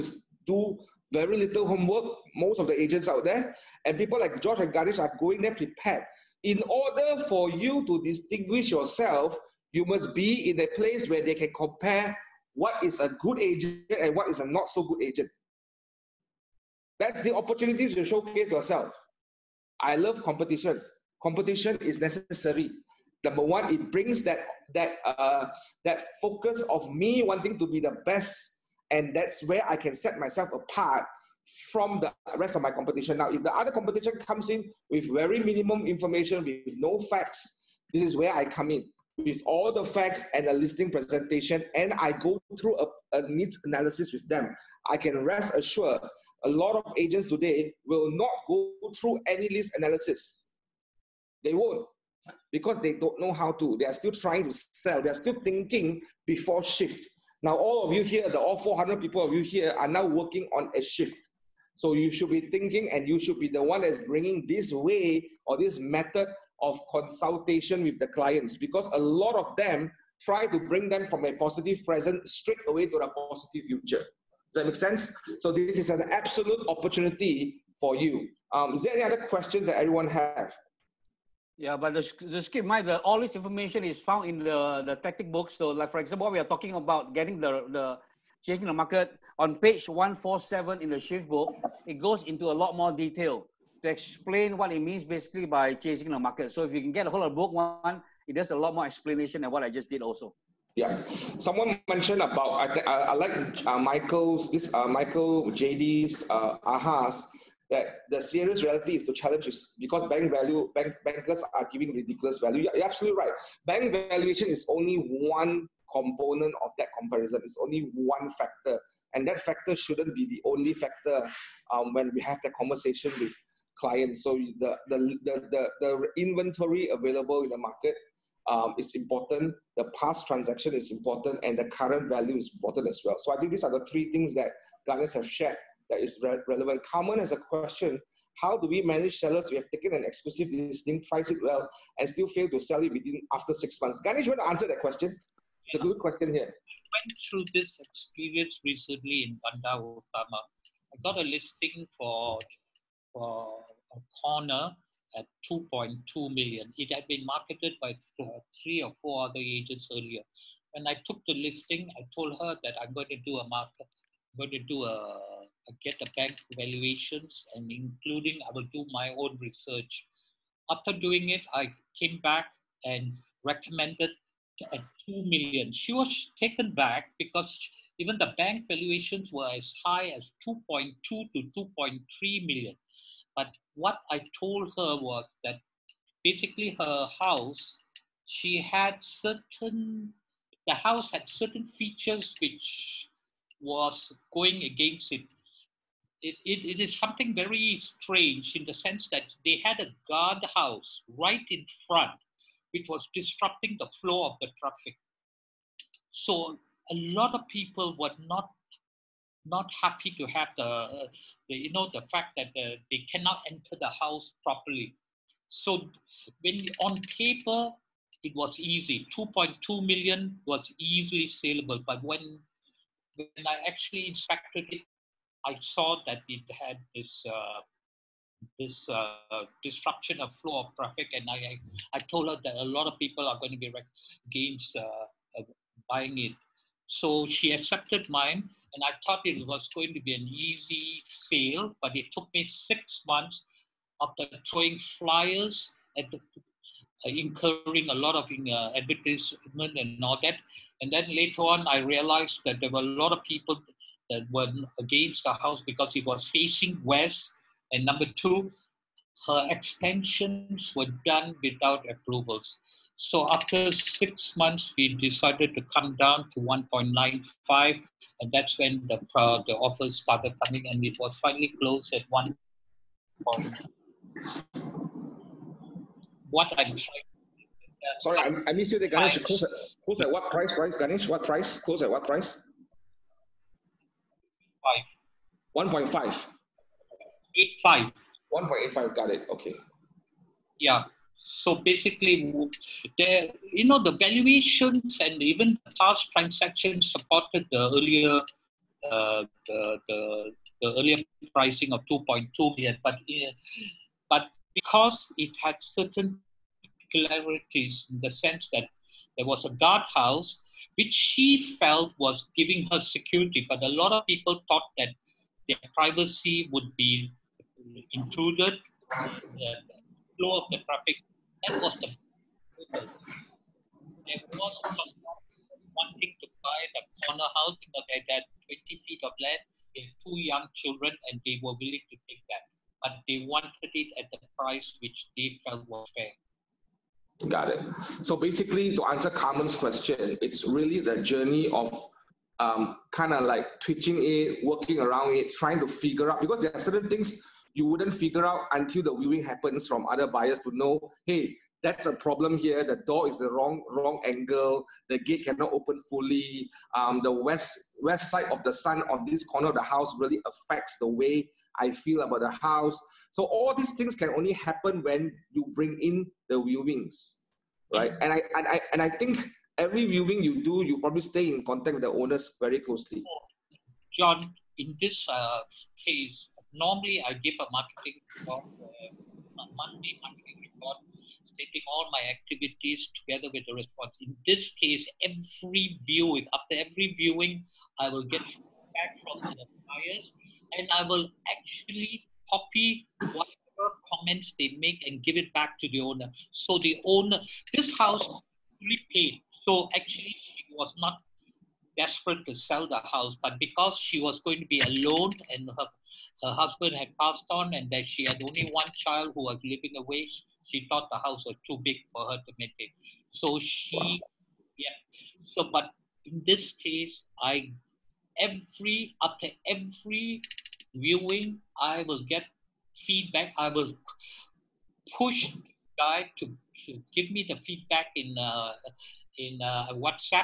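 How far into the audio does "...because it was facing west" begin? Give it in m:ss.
4:15.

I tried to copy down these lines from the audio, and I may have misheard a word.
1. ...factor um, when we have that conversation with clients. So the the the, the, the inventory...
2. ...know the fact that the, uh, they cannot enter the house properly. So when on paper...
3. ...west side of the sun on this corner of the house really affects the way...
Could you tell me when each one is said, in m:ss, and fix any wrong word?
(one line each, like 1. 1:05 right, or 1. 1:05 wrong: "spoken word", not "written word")
1. 2:00 right
2. 3:31 right
3. 5:57 right.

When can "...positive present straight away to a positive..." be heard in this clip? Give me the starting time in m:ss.
1:11.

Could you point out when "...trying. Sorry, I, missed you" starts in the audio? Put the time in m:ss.
4:36.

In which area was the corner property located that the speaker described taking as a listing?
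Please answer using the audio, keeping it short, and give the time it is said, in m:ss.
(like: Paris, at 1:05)
Bandar Utama, at 2:29.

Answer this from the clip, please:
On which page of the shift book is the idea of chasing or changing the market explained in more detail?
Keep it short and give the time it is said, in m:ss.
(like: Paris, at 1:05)
147, at 1:29.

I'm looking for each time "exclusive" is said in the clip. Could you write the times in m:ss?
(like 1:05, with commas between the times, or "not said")
2:20.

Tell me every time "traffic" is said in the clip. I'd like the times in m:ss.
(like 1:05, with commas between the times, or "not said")
3:24, 3:50, 5:20.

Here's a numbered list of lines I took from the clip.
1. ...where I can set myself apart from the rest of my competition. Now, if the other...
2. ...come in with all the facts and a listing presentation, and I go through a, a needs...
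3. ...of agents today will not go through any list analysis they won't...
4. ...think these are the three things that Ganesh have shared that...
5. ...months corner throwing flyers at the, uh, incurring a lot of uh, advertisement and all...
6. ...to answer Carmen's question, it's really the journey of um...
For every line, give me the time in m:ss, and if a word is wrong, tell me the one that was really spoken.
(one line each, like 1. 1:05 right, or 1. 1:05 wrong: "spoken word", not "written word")
1. 0:29 right
2. 0:38 right
3. 0:46 right
4. 2:13 right
5. 4:03 wrong: "after", not "corner"
6. 5:38 right.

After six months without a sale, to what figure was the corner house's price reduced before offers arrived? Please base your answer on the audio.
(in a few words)
1.95 million.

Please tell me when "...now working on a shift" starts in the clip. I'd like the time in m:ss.
0:59.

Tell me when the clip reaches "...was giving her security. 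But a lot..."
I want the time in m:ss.
5:11.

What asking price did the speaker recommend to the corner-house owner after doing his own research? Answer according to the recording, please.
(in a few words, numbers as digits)
2 million.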